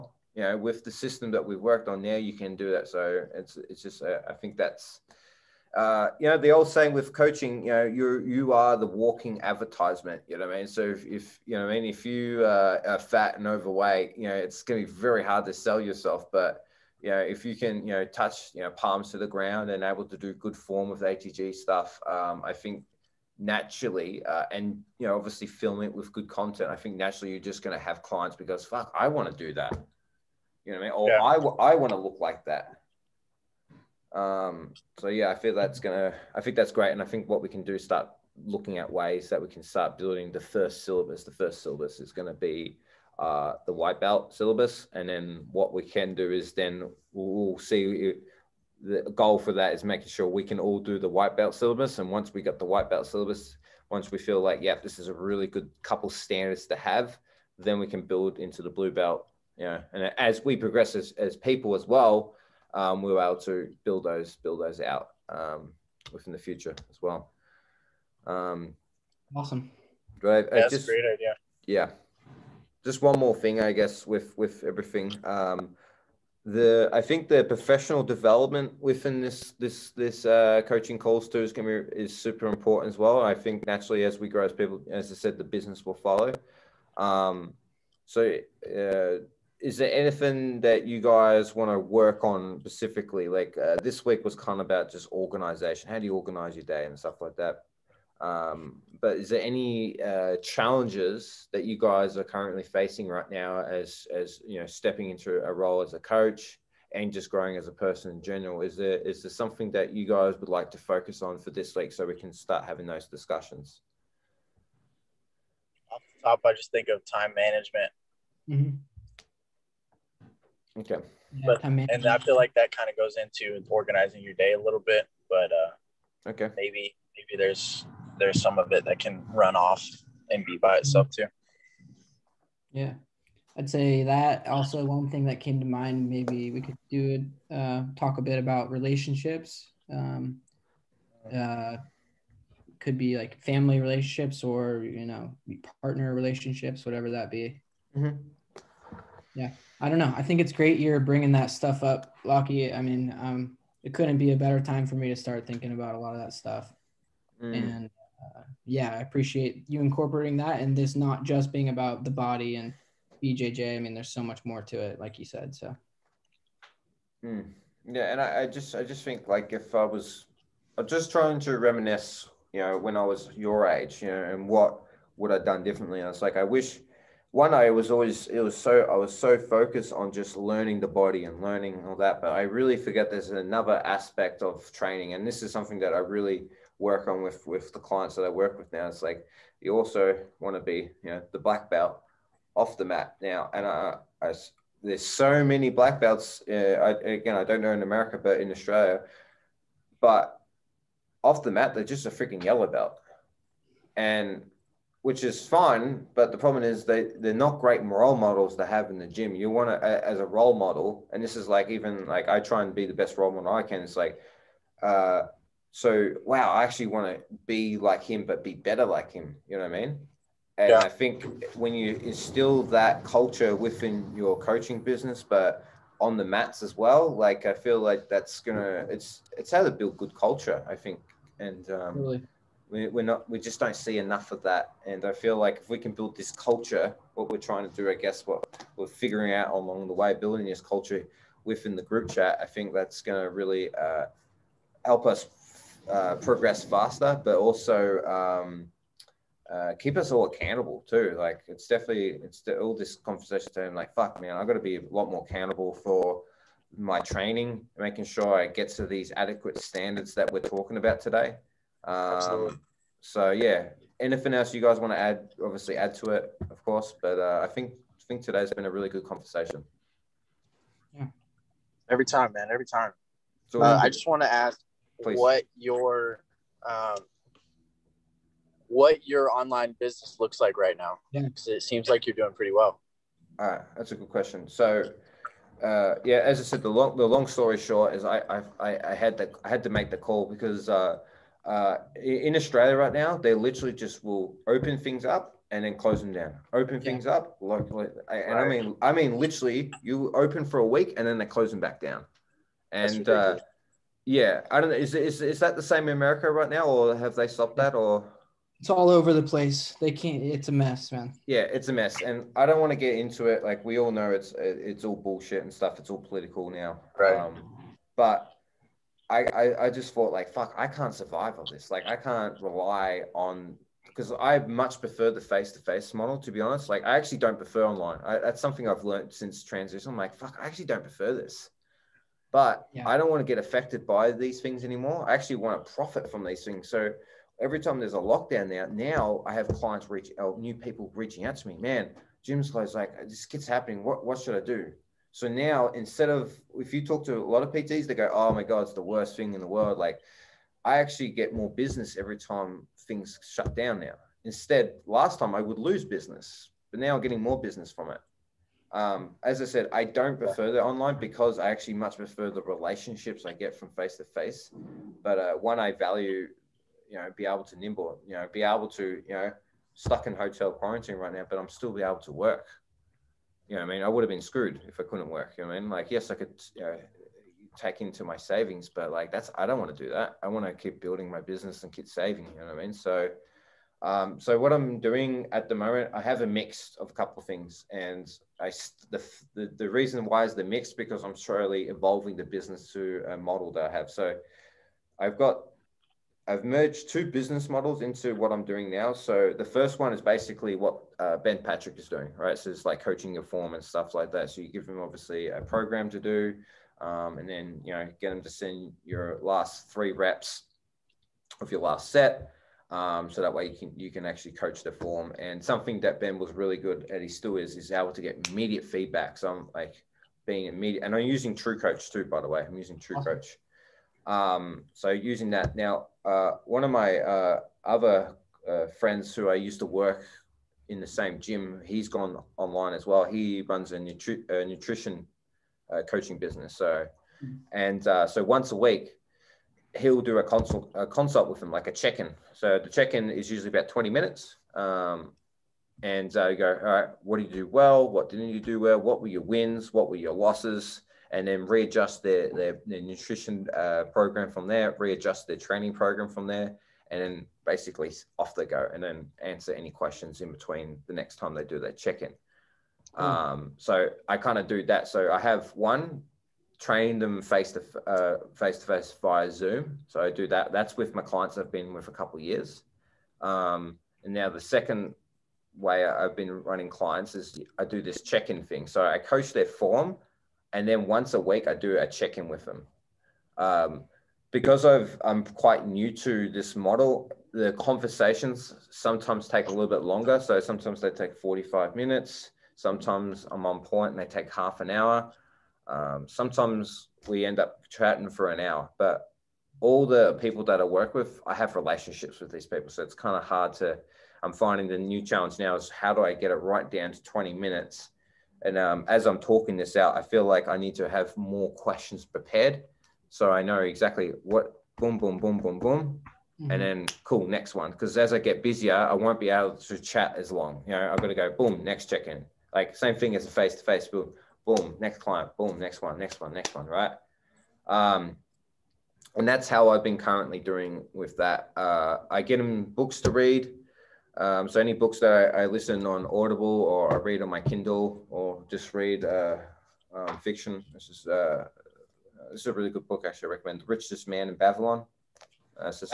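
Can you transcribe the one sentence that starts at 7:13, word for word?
He runs a, nutri- a nutrition uh, coaching business.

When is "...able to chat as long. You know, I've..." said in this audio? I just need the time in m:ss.
8:39.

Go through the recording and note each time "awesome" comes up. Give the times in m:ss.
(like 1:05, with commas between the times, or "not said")
1:09, 7:02.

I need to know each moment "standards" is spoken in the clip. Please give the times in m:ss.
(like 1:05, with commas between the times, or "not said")
0:56, 4:19.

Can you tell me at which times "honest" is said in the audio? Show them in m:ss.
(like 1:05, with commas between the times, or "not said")
5:26.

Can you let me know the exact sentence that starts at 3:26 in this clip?
But the problem is they they're not great role models to have in the gym.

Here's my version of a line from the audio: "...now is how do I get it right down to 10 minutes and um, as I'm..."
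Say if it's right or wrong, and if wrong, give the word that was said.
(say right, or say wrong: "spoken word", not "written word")
wrong: "20", not "10".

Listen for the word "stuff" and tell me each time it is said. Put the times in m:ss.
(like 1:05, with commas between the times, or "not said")
0:21, 1:36, 2:31, 2:36, 5:15, 6:43.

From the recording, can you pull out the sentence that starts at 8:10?
So sometimes they take 45 minutes.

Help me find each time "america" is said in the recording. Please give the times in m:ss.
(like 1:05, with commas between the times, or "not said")
3:17, 5:05.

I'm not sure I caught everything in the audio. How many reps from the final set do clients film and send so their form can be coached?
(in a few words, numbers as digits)
3.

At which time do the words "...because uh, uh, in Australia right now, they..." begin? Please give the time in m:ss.
4:50.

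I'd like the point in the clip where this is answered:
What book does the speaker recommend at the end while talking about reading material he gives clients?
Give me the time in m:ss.
9:03.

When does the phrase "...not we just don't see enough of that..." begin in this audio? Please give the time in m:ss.
3:53.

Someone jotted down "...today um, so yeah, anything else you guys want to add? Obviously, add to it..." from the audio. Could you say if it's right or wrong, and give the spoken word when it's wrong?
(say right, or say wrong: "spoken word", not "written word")
right.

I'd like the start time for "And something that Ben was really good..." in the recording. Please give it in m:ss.
6:55.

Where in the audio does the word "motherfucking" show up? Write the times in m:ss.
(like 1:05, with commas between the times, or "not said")
not said.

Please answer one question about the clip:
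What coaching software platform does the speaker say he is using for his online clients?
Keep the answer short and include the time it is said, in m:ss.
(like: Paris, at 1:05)
TrueCoach, at 7:01.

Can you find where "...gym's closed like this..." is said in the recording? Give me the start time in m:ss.
5:42.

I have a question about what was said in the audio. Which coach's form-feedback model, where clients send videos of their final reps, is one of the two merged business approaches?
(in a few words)
Ben Patrick.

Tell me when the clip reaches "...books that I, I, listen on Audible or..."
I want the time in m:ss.
8:54.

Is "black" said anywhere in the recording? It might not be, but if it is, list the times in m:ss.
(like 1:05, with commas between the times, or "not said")
3:11, 3:15.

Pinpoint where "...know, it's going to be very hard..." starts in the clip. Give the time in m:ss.
0:14.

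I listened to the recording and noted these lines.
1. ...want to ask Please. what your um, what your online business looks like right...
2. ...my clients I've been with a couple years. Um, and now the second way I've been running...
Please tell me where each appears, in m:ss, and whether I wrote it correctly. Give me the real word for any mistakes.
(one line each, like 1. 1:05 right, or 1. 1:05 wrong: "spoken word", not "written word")
1. 4:34 right
2. 7:50 right.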